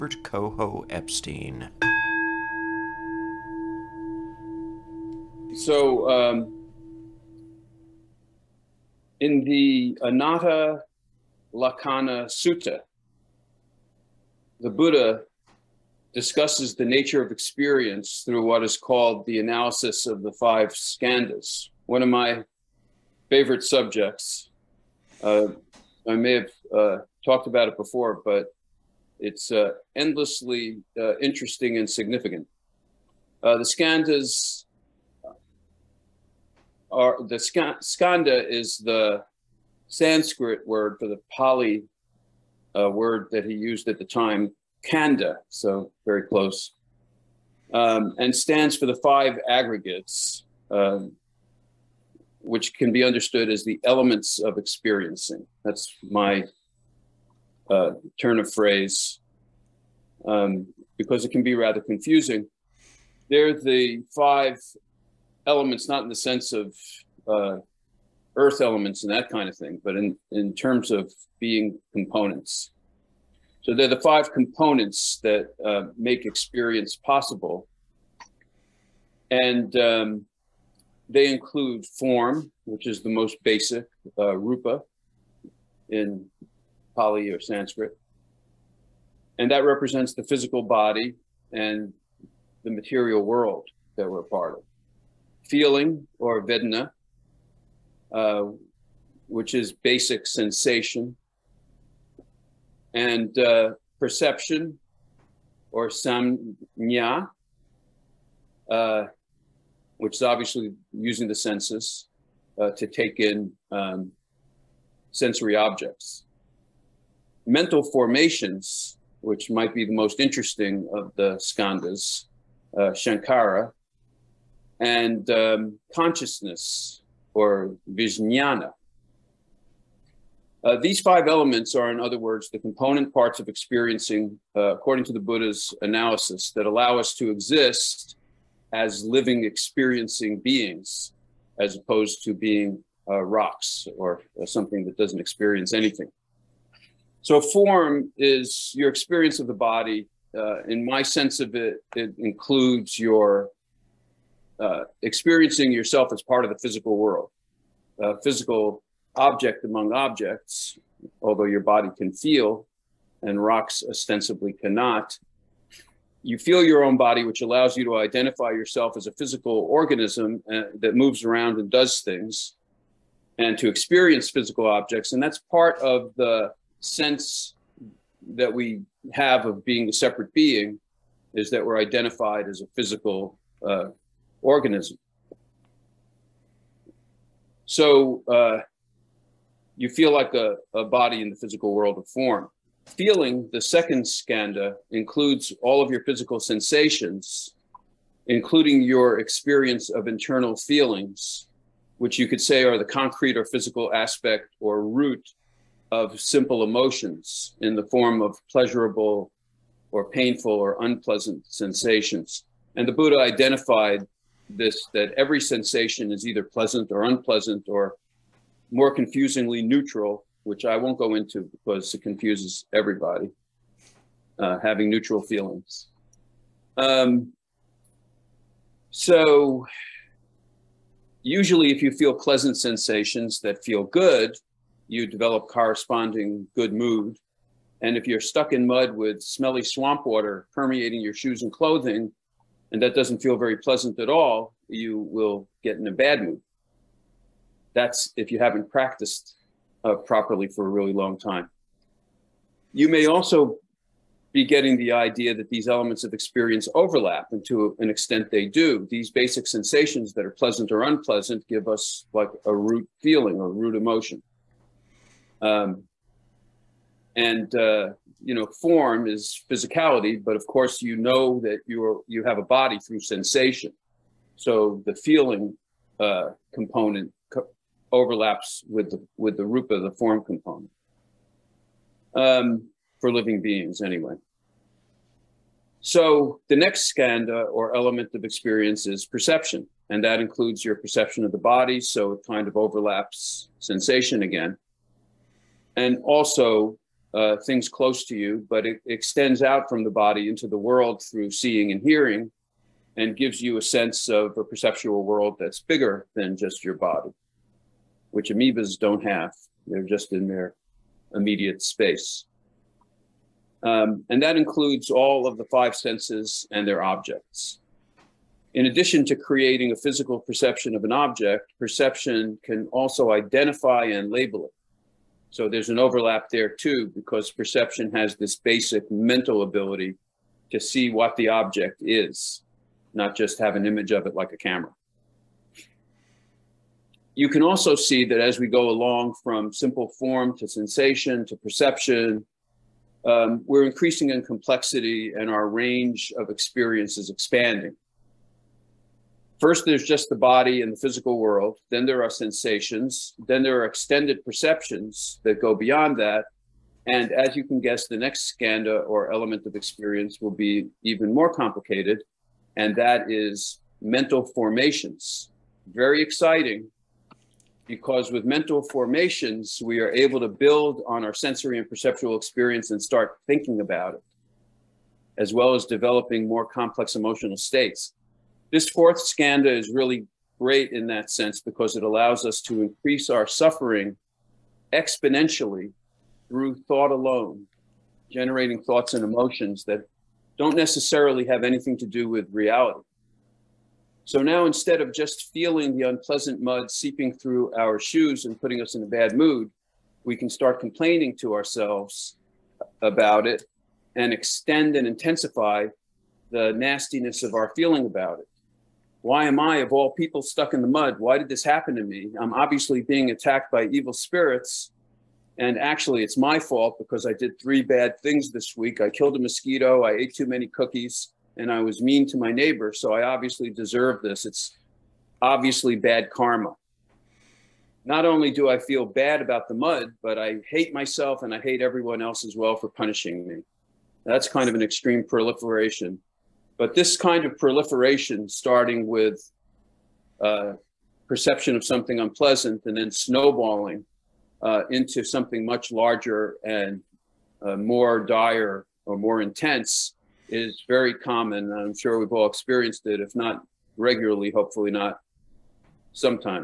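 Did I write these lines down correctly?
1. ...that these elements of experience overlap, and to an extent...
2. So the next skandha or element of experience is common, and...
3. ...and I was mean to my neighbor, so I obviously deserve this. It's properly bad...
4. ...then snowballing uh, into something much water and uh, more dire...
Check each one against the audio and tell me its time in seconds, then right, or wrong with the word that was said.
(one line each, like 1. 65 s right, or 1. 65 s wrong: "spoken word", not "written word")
1. 255 s right
2. 285 s wrong: "perception", not "common"
3. 421 s wrong: "obviously", not "properly"
4. 442 s wrong: "larger", not "water".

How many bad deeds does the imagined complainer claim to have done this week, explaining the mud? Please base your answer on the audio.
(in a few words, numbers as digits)
3.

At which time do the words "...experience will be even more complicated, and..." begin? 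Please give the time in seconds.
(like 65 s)
359 s.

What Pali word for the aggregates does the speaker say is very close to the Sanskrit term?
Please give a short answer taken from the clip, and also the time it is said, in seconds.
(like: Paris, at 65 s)
kanda, at 44 s.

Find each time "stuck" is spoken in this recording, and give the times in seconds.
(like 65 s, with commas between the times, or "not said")
238 s, 410 s.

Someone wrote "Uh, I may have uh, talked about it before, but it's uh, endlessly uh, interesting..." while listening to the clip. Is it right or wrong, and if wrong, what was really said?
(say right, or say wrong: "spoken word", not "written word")
right.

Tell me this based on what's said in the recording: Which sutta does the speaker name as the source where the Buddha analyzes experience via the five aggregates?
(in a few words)
Anatta Lakkhana Sutta.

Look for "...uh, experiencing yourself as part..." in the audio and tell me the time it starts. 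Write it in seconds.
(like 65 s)
154 s.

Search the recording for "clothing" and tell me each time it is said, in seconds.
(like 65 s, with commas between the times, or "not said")
241 s.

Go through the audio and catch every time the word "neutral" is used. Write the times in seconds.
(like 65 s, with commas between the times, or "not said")
219 s, 224 s.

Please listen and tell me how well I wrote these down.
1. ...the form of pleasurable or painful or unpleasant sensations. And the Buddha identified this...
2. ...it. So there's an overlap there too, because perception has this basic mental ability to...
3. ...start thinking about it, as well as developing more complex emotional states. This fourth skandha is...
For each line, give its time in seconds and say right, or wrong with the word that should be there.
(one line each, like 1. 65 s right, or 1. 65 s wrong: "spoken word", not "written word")
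1. 207 s right
2. 324 s right
3. 372 s right.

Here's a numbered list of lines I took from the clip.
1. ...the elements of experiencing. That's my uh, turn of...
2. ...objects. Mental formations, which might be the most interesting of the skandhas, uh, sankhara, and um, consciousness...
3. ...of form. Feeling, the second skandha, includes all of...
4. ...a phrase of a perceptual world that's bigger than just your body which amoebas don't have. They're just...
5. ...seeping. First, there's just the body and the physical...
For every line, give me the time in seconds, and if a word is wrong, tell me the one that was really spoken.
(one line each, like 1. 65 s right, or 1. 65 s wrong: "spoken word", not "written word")
1. 53 s right
2. 115 s right
3. 191 s right
4. 303 s wrong: "sense", not "phrase"
5. 347 s wrong: "expanding", not "seeping".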